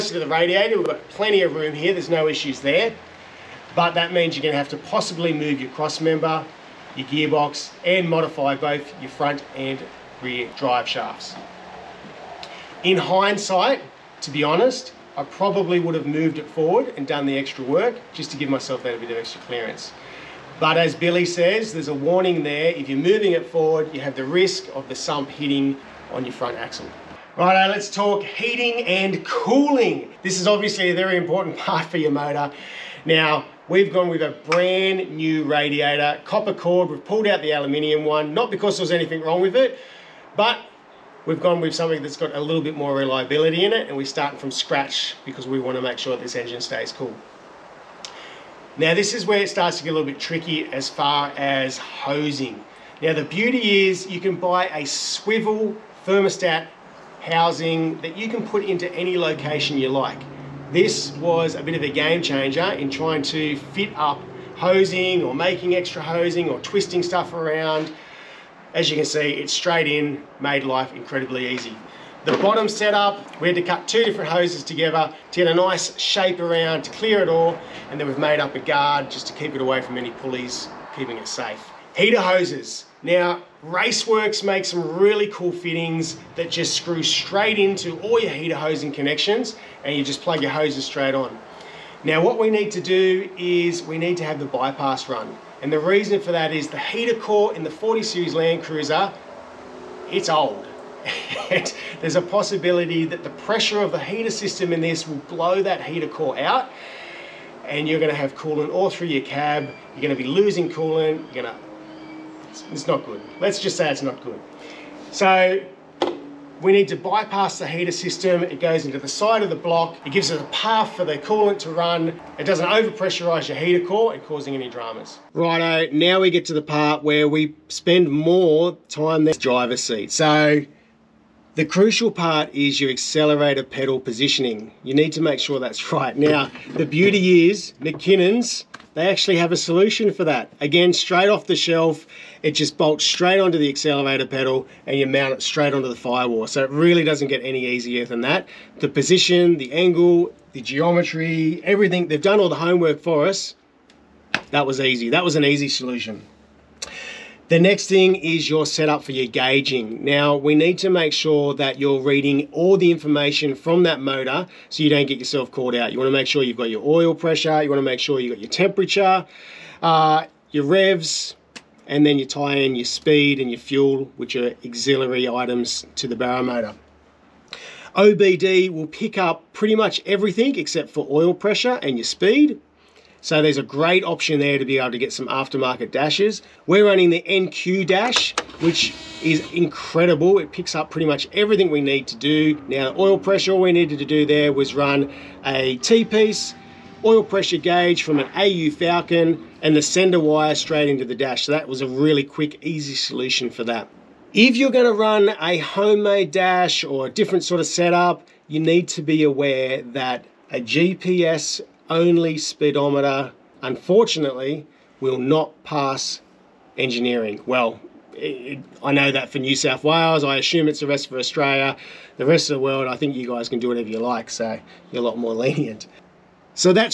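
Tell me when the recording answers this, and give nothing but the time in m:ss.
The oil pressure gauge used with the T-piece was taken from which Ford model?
3:18.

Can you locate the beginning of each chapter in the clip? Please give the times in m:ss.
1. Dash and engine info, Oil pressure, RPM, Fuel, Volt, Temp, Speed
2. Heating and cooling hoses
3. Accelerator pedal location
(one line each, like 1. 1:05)
1. 2:36
2. 0:28
3. 2:06.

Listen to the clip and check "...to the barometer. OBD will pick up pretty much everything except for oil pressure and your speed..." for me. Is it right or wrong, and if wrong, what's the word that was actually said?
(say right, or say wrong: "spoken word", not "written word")
right.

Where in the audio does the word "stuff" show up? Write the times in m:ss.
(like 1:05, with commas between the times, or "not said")
1:07.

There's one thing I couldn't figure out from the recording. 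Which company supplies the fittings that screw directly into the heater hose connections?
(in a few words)
Raceworks.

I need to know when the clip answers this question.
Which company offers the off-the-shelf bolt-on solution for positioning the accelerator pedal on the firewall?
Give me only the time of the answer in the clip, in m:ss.
2:17.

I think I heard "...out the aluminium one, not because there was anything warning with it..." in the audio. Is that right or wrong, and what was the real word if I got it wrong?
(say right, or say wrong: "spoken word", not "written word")
wrong: "wrong", not "warning".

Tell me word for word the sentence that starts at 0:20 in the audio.
But as Billy says, there's a warning there.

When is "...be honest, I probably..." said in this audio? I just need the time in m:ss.
0:14.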